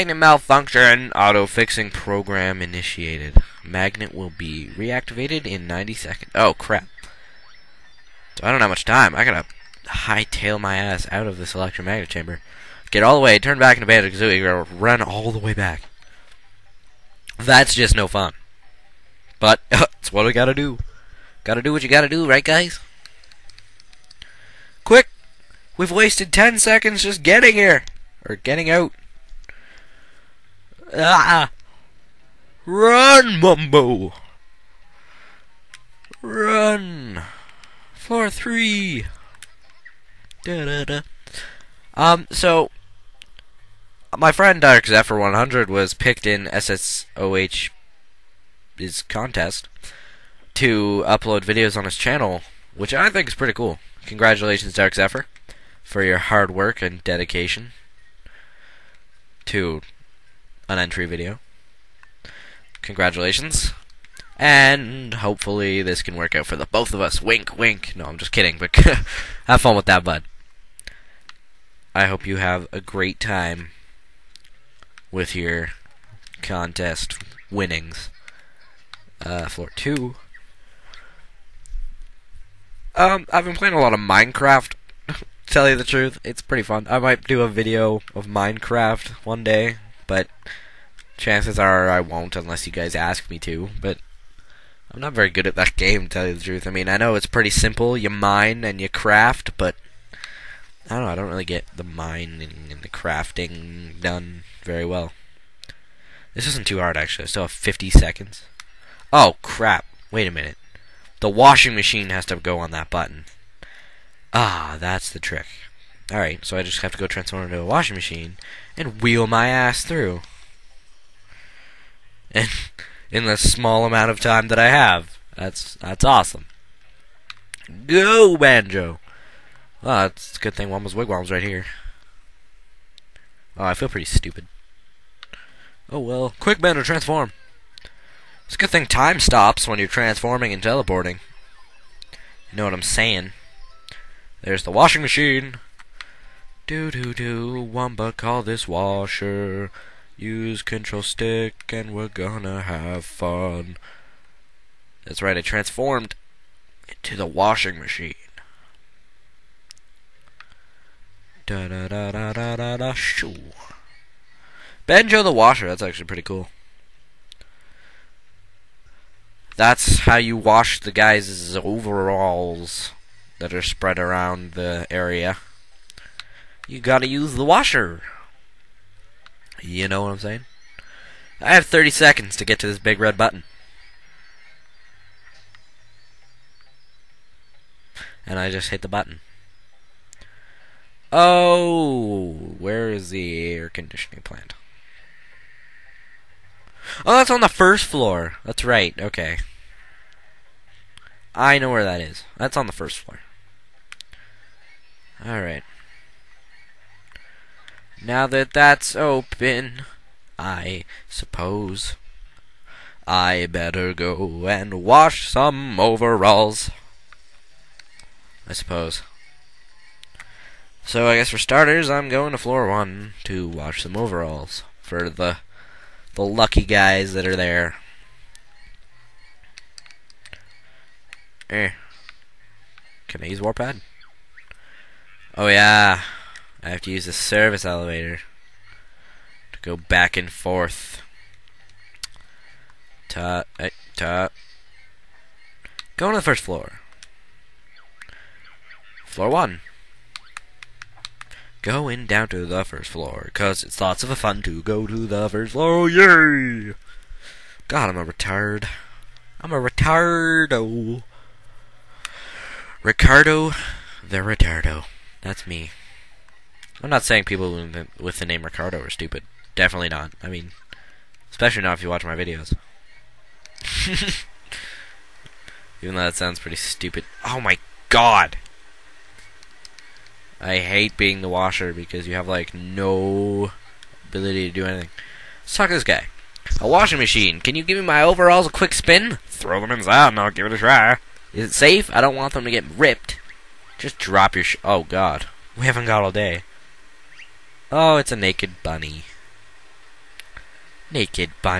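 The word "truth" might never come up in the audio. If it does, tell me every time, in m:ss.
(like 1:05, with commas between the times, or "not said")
1:25, 1:36.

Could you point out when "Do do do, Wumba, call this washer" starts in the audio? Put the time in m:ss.
2:26.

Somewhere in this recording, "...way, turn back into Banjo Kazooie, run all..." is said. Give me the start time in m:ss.
0:13.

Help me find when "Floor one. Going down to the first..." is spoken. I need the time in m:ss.
4:09.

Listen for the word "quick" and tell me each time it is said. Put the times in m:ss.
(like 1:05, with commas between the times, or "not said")
0:24, 2:16, 4:48.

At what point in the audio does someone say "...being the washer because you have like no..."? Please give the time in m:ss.
4:40.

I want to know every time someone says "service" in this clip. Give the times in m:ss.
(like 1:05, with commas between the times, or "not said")
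3:57.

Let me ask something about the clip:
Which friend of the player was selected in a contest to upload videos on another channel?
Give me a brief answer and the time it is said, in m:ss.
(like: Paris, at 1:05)
Dark Zephyr 100, at 0:44.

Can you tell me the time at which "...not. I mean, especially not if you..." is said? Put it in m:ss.
4:29.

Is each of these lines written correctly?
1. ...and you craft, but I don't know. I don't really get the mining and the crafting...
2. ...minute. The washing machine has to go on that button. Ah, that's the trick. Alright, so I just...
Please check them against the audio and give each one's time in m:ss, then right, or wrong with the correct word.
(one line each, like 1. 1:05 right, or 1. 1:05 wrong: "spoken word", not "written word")
1. 1:38 right
2. 1:50 right.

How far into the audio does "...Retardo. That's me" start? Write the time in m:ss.
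4:24.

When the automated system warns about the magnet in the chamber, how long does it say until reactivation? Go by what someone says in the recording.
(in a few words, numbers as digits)
90 seconds.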